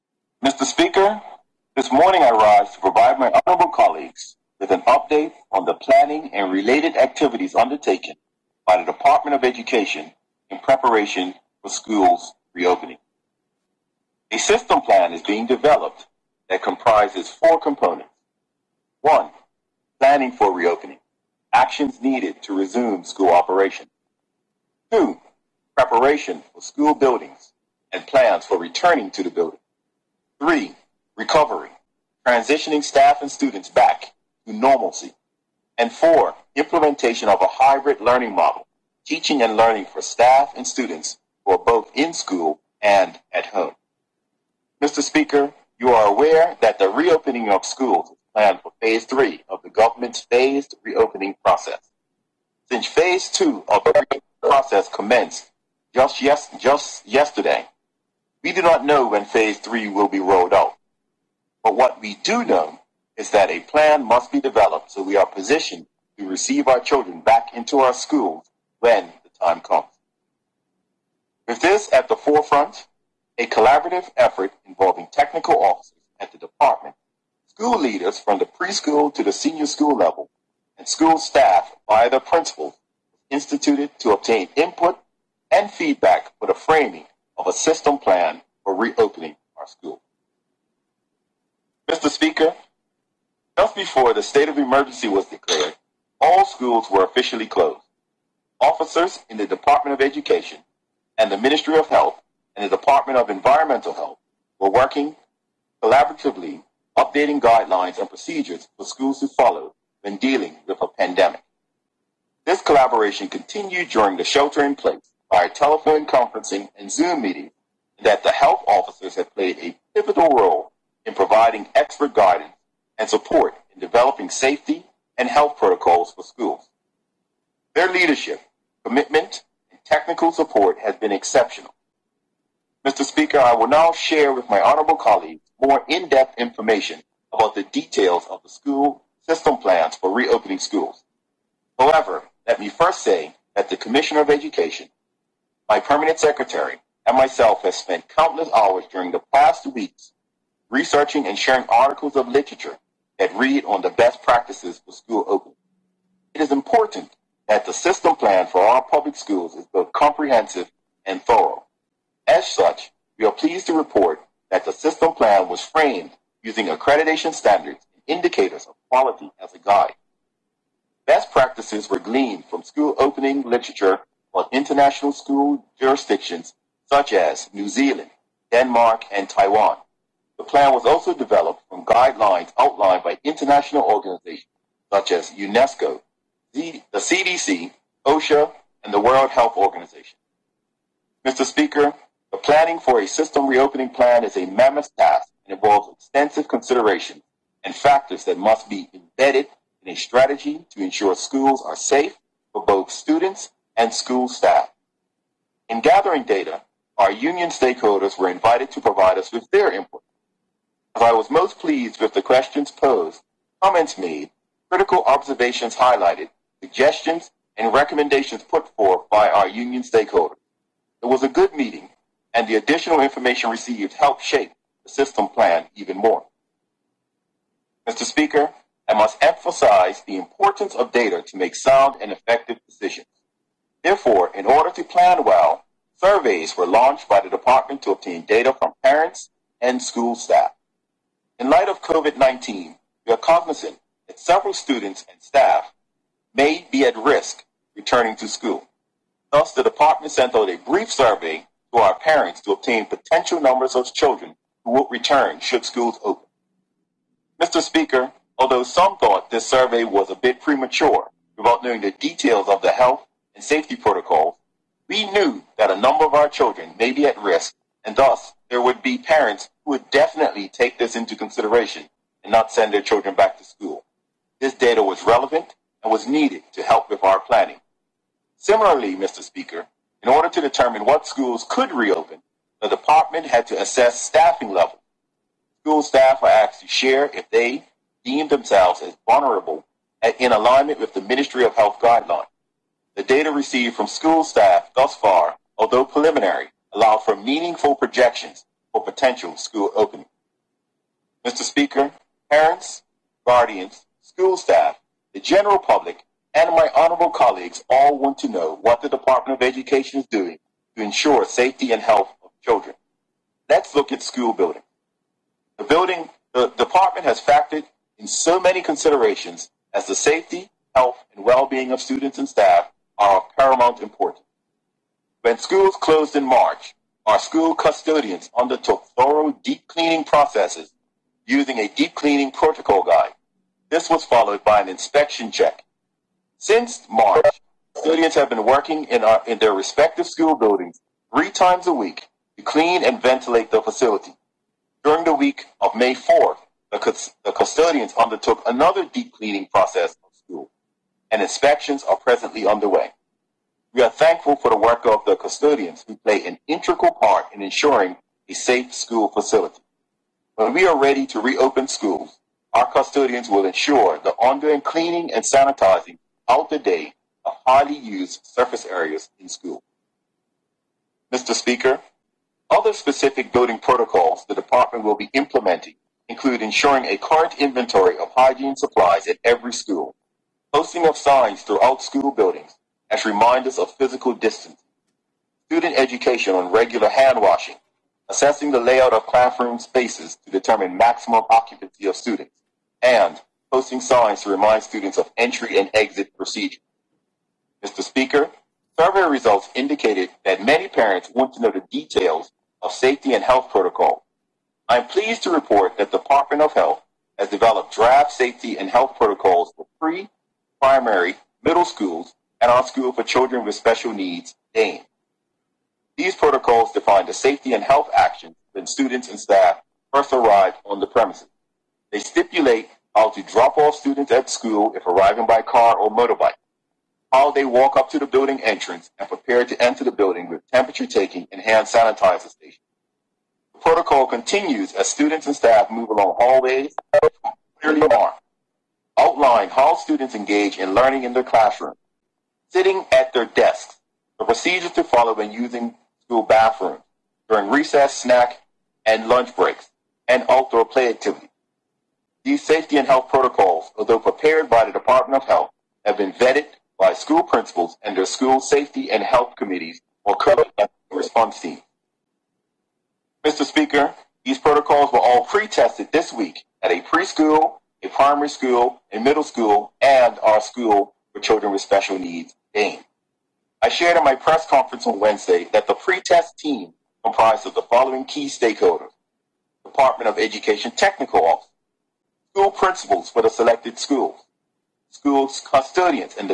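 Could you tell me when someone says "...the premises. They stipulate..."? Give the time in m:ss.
7:00.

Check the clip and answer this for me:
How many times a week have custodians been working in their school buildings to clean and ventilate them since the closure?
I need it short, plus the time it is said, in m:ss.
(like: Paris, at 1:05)
3, at 5:41.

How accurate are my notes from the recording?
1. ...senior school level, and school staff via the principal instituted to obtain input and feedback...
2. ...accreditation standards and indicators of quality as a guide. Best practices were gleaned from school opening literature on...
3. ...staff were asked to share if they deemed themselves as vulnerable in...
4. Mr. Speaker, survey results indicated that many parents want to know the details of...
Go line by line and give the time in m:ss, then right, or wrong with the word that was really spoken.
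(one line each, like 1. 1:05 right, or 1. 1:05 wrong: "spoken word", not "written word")
1. 1:19 right
2. 2:46 right
3. 4:45 right
4. 6:37 right.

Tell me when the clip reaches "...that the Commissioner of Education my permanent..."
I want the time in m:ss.
2:23.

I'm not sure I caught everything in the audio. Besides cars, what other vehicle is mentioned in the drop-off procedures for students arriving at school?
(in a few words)
Motorbike.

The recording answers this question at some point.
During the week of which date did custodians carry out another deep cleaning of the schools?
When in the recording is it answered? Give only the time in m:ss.
5:45.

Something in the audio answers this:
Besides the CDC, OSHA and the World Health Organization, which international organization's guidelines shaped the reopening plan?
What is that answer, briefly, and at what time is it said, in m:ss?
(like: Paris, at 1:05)
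UNESCO, at 3:05.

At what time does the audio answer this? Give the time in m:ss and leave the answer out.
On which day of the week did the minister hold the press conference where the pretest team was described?
7:54.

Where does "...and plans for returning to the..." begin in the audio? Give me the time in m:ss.
0:27.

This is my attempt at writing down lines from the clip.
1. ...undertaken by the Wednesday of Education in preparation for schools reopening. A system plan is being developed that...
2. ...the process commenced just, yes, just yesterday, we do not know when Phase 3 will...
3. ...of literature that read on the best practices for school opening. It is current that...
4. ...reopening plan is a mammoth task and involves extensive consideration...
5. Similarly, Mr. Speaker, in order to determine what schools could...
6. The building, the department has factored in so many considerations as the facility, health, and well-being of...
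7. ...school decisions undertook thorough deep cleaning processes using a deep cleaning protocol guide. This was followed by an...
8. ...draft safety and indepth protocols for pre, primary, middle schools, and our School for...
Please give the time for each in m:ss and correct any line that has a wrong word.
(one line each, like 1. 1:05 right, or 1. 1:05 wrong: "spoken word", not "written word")
1. 0:07 wrong: "Department", not "Wednesday"
2. 0:53 right
3. 2:32 wrong: "important", not "current"
4. 3:13 right
5. 4:38 right
6. 5:15 wrong: "safety", not "facility"
7. 5:27 wrong: "custodians", not "decisions"
8. 6:47 wrong: "health", not "indepth".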